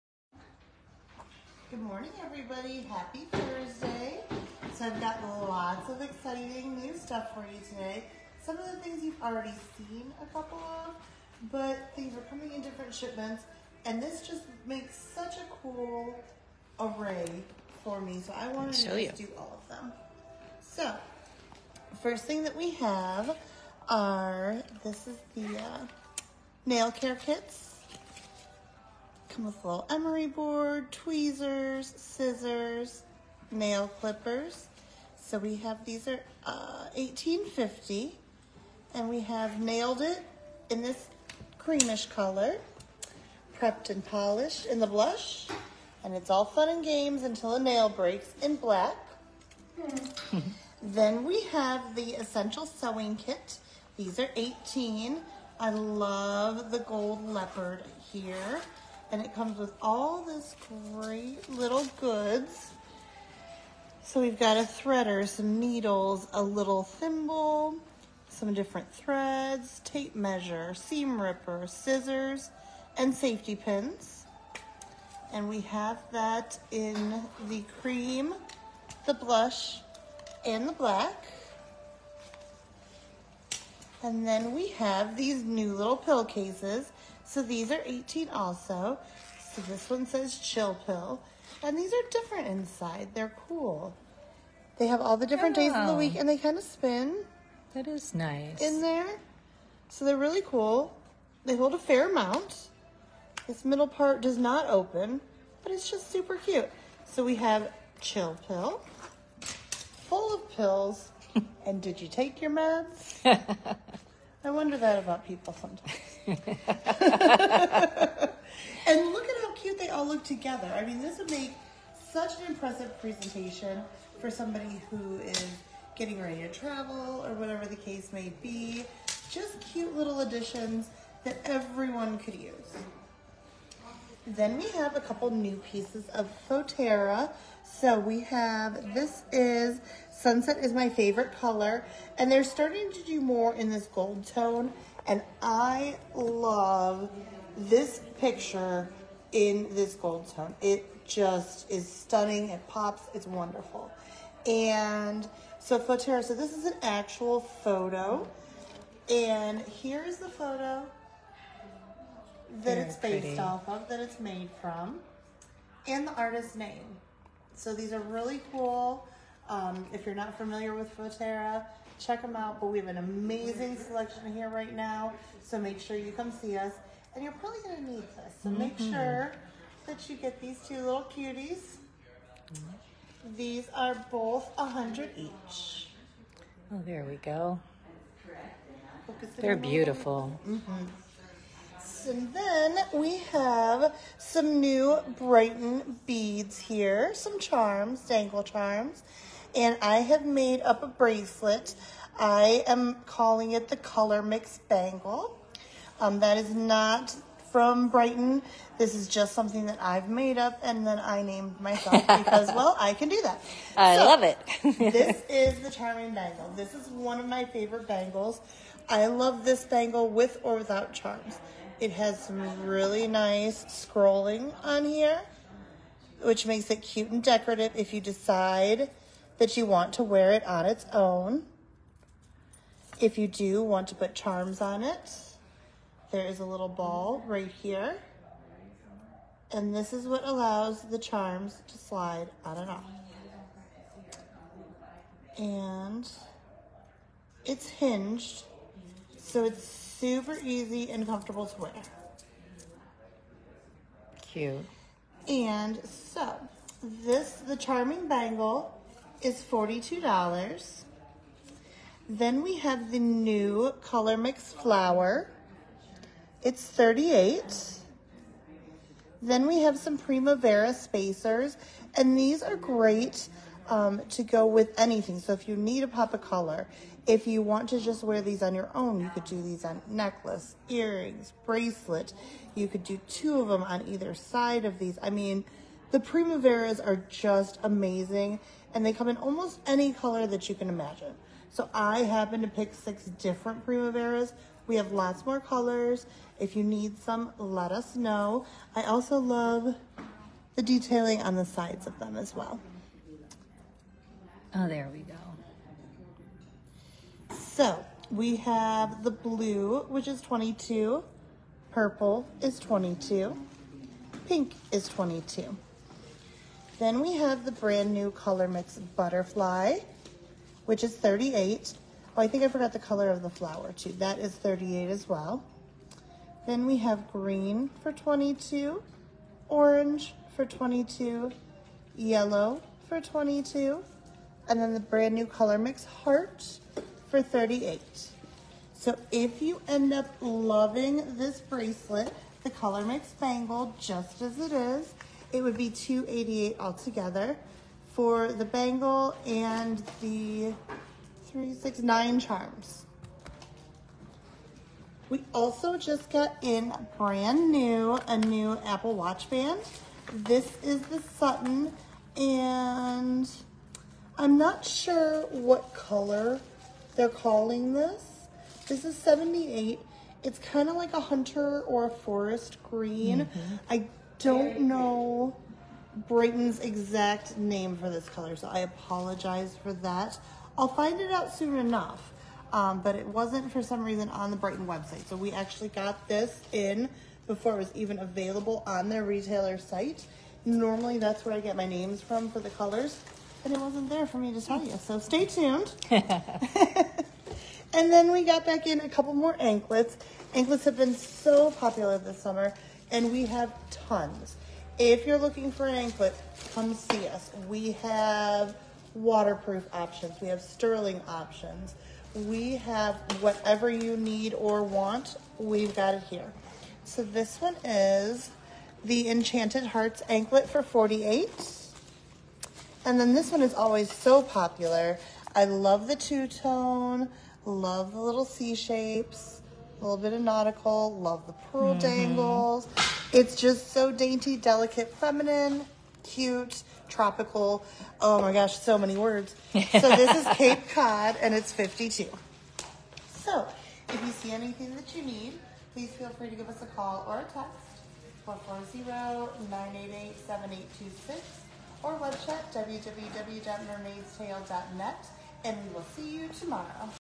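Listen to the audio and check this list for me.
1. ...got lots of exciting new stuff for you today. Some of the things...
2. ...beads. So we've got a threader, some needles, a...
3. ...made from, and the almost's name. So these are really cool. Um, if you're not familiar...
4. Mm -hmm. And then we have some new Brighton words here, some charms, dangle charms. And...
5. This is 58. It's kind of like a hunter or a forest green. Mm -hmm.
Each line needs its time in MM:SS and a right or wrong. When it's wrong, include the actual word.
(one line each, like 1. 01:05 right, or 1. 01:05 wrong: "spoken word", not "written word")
1. 00:04 right
2. 01:01 wrong: "goods", not "beads"
3. 02:44 wrong: "artist", not "almost"
4. 03:10 wrong: "beads", not "words"
5. 06:08 wrong: "78", not "58".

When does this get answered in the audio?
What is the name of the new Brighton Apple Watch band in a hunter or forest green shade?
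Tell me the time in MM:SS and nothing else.
06:01.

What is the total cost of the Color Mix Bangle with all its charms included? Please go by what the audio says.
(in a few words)
288.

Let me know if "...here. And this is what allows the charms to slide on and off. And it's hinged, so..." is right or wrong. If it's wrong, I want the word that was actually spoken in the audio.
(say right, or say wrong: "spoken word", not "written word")
right.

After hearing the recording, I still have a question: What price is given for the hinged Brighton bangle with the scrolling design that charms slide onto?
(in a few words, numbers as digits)
$42.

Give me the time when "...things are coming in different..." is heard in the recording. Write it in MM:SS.
00:11.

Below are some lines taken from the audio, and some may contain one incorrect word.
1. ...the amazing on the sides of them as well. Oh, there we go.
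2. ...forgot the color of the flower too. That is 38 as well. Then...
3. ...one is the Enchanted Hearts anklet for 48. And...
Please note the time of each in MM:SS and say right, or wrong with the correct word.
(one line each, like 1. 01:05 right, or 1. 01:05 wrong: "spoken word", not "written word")
1. 05:00 wrong: "detailing", not "amazing"
2. 05:22 right
3. 06:57 right.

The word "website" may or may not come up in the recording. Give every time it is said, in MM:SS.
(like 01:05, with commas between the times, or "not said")
06:24, 07:31.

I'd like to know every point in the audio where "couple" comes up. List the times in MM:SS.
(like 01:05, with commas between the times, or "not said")
00:10, 02:14, 06:38.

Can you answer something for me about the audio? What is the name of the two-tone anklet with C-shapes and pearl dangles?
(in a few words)
Cape Cod.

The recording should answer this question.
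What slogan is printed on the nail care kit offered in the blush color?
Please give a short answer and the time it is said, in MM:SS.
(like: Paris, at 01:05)
Prepped and polished, at 00:43.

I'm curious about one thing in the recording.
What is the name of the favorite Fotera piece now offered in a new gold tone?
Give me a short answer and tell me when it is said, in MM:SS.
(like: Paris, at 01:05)
Sunset, at 02:20.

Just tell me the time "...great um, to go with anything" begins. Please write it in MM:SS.
04:32.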